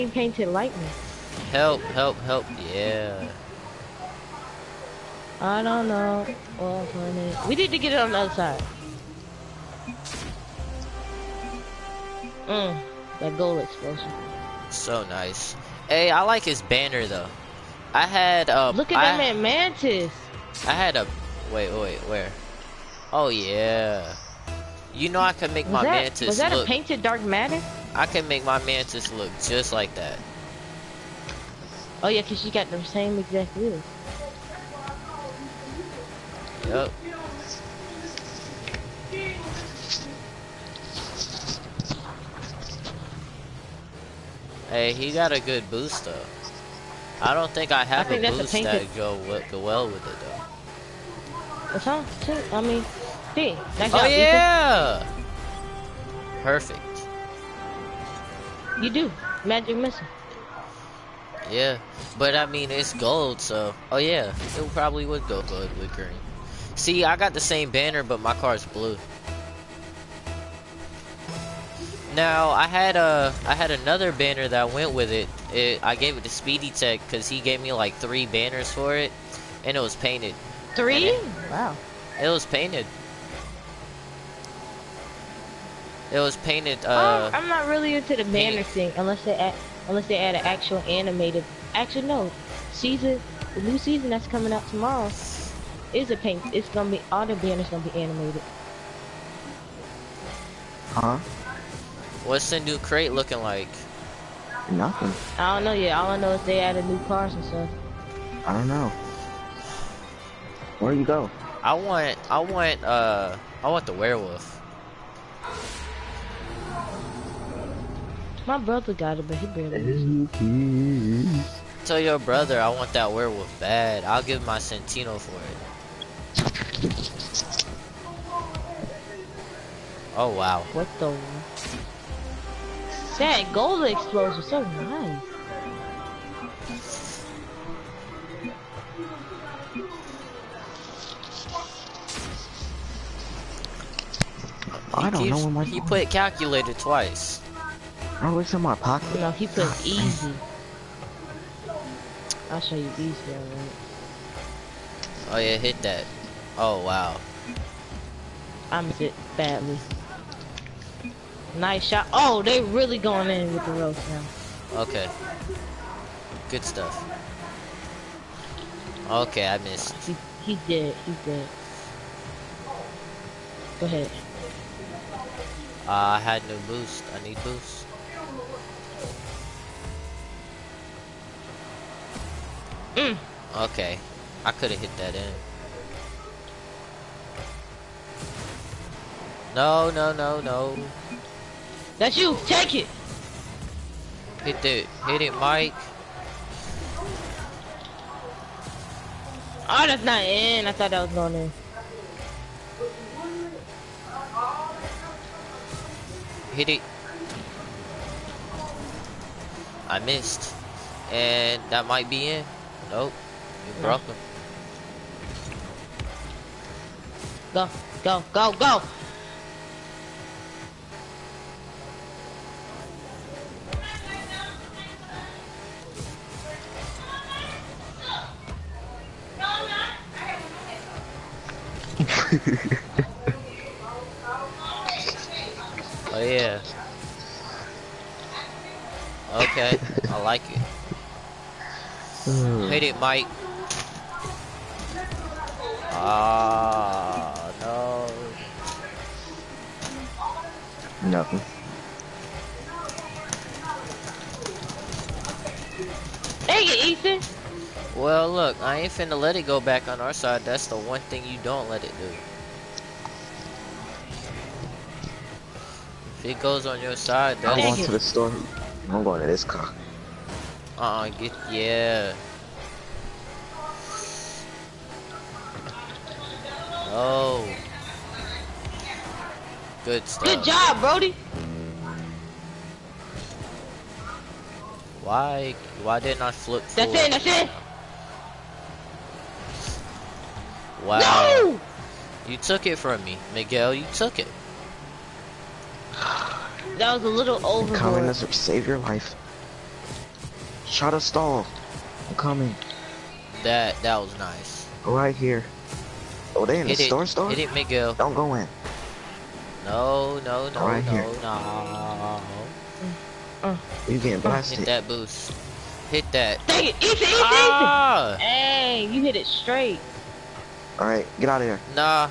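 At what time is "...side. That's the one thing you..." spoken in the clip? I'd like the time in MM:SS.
04:20.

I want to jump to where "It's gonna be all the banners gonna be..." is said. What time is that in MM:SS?
01:36.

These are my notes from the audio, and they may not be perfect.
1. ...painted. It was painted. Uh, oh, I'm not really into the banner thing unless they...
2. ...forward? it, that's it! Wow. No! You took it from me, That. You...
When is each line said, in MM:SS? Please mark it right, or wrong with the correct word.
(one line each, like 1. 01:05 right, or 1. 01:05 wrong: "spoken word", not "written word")
1. 01:22 right
2. 04:46 wrong: "Miguel", not "That".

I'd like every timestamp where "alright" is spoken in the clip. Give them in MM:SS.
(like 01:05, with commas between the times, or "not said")
02:33, 05:20.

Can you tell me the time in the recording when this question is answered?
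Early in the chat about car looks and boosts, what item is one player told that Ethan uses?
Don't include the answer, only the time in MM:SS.
00:59.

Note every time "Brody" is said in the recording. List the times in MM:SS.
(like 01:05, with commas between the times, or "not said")
04:40.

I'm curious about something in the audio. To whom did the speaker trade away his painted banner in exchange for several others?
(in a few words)
Speedy Tech.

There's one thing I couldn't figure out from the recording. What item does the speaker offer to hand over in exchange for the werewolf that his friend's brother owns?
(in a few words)
Centino.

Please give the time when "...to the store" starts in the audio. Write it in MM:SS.
04:27.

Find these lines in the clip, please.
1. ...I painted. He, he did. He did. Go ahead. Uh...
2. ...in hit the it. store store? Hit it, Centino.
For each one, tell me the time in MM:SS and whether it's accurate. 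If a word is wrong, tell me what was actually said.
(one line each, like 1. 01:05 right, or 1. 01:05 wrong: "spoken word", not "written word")
1. 02:49 wrong: "missed", not "painted"
2. 05:06 wrong: "Miguel", not "Centino".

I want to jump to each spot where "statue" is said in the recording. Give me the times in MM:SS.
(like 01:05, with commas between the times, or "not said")
not said.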